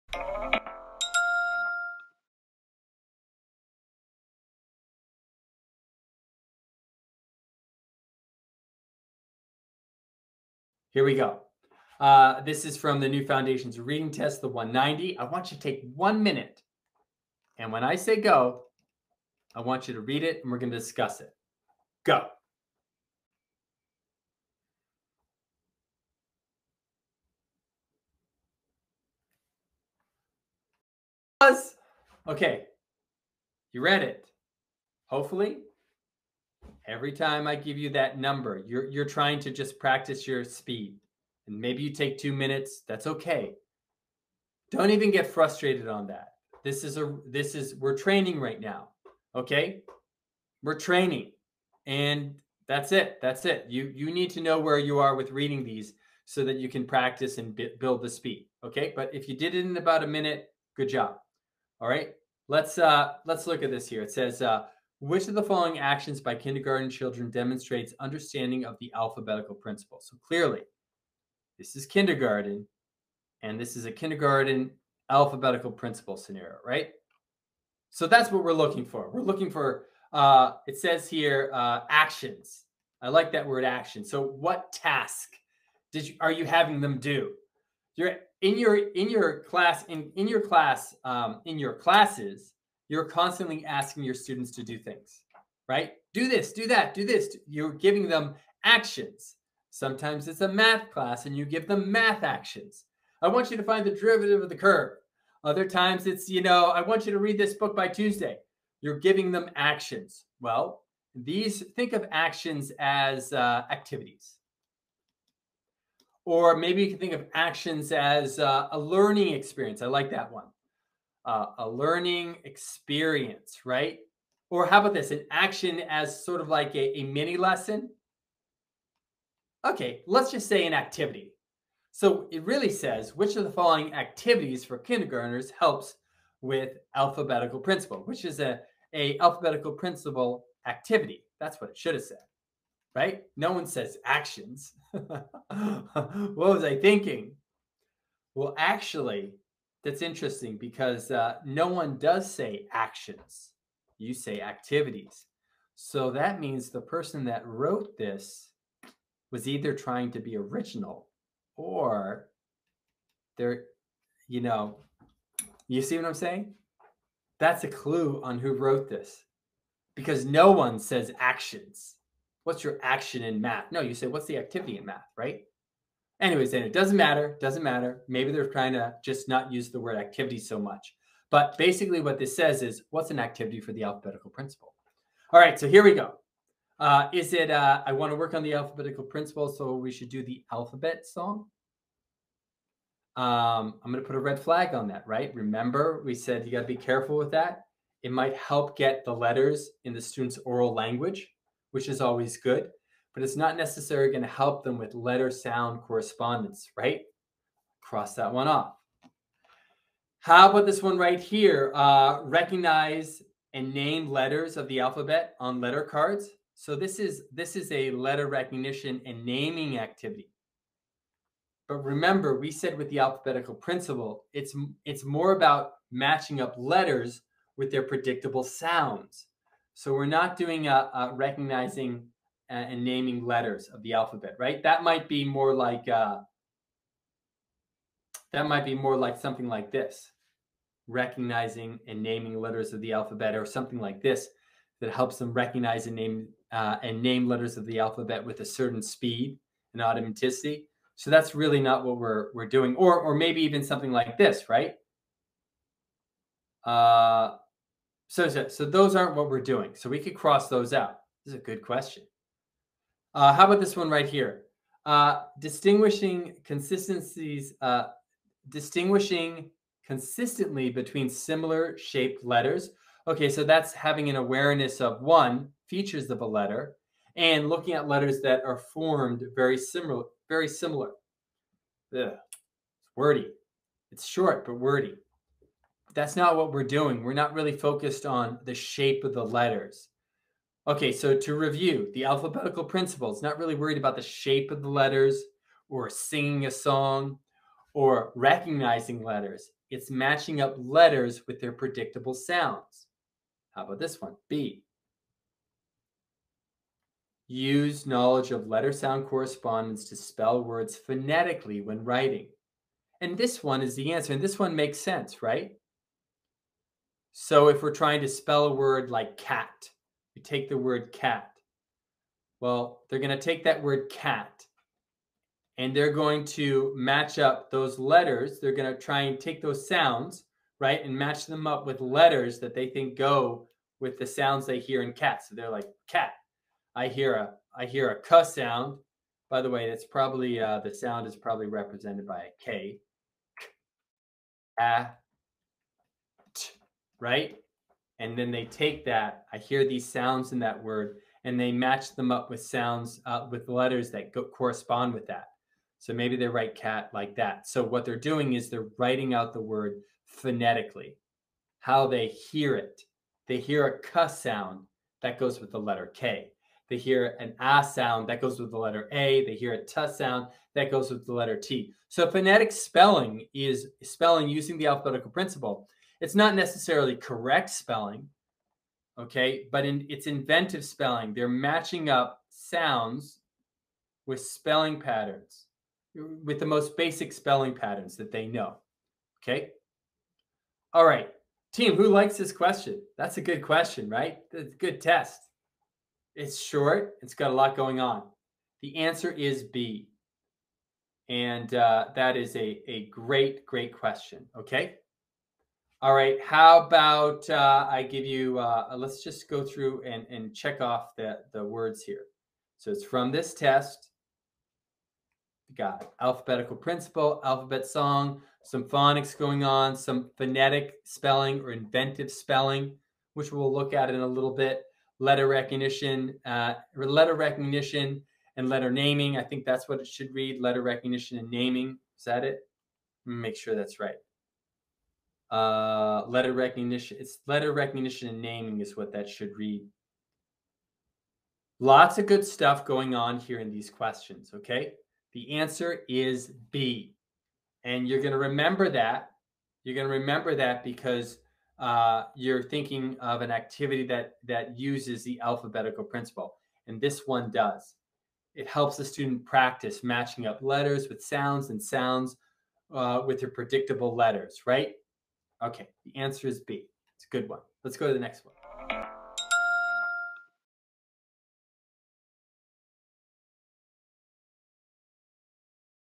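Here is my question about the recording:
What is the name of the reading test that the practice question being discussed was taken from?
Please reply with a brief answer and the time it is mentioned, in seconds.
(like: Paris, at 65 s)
New Foundations Reading Test, at 13 s.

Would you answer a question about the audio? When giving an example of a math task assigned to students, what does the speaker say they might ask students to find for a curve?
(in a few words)
The derivative.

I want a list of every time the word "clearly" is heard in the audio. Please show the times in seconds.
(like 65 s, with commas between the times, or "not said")
70 s.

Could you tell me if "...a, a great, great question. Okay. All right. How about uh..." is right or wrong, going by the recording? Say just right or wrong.
right.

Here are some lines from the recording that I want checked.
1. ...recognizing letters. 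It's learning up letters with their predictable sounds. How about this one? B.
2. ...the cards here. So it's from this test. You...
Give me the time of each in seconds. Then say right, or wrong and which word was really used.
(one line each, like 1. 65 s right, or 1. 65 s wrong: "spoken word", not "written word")
1. 298 s wrong: "matching", not "learning"
2. 411 s wrong: "words", not "cards".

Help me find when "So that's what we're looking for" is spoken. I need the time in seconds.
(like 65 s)
77 s.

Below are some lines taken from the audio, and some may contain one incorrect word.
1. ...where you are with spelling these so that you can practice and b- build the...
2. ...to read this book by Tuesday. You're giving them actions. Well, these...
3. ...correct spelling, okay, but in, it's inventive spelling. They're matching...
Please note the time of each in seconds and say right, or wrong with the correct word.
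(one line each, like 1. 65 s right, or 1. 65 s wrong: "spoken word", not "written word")
1. 54 s wrong: "reading", not "spelling"
2. 107 s right
3. 376 s right.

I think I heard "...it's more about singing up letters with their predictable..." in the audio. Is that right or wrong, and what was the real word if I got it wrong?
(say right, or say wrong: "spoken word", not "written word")
wrong: "matching", not "singing".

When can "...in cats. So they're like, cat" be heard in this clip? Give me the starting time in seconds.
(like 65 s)
334 s.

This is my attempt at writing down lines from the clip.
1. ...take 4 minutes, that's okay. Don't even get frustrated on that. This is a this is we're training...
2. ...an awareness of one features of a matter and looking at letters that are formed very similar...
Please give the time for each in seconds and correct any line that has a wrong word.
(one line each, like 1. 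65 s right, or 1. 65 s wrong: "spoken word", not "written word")
1. 41 s wrong: "2", not "4"
2. 274 s wrong: "letter", not "matter".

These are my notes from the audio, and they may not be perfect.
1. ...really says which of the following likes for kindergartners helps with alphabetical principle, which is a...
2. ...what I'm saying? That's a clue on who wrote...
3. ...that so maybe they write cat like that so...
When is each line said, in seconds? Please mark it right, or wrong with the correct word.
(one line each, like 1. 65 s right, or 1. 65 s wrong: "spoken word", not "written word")
1. 132 s wrong: "activities", not "likes"
2. 165 s right
3. 355 s right.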